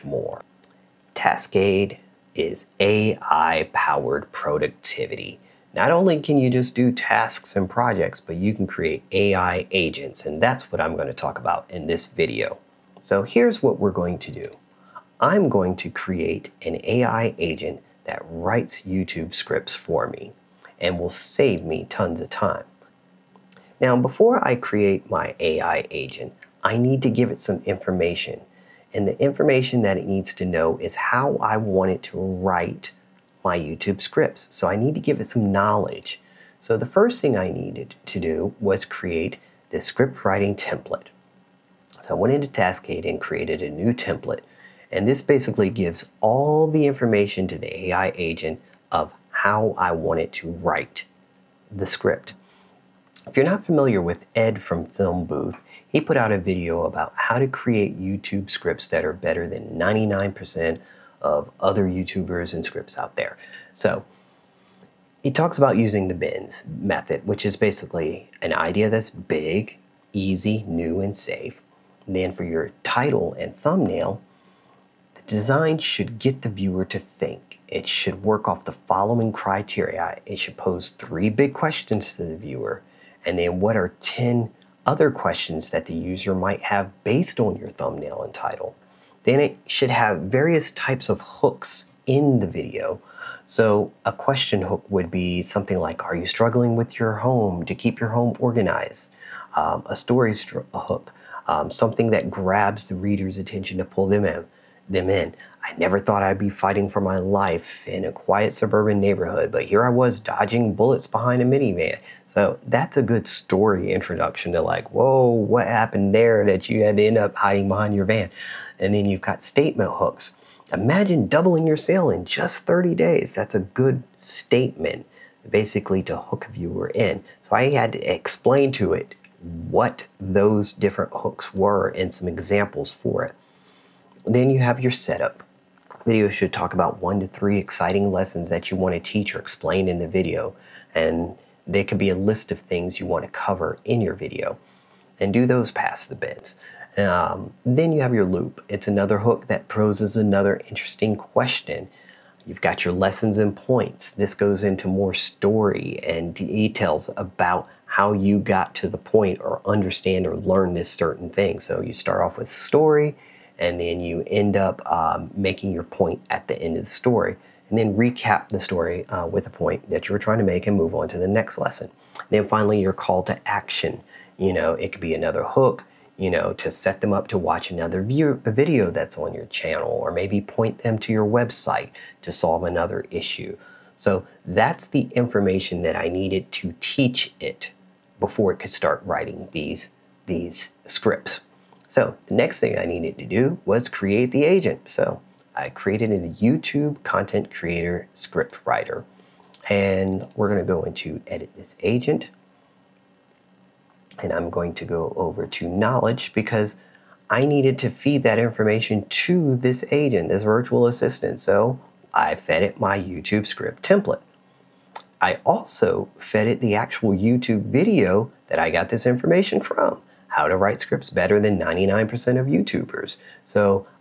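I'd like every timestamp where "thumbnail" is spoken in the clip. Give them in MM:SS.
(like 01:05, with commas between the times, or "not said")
01:13, 01:27.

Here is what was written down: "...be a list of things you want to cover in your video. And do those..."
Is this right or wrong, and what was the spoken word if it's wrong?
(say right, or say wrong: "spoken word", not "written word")
right.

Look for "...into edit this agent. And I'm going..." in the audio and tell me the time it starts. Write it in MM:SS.
03:20.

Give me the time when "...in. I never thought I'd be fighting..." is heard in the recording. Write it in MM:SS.
01:45.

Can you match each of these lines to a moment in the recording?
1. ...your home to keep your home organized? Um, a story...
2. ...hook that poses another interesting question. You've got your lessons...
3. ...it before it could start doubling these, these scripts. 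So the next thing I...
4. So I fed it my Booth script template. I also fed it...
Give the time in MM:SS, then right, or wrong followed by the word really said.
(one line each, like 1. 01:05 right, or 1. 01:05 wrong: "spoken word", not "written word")
1. 01:36 right
2. 02:29 right
3. 03:07 wrong: "writing", not "doubling"
4. 03:31 wrong: "YouTube", not "Booth".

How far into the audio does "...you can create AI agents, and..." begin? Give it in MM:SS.
00:08.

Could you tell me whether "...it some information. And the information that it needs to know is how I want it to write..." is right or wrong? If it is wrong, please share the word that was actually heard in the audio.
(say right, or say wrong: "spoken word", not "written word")
right.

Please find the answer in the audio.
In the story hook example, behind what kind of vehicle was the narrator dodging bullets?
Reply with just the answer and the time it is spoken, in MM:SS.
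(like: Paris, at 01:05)
minivan, at 01:51.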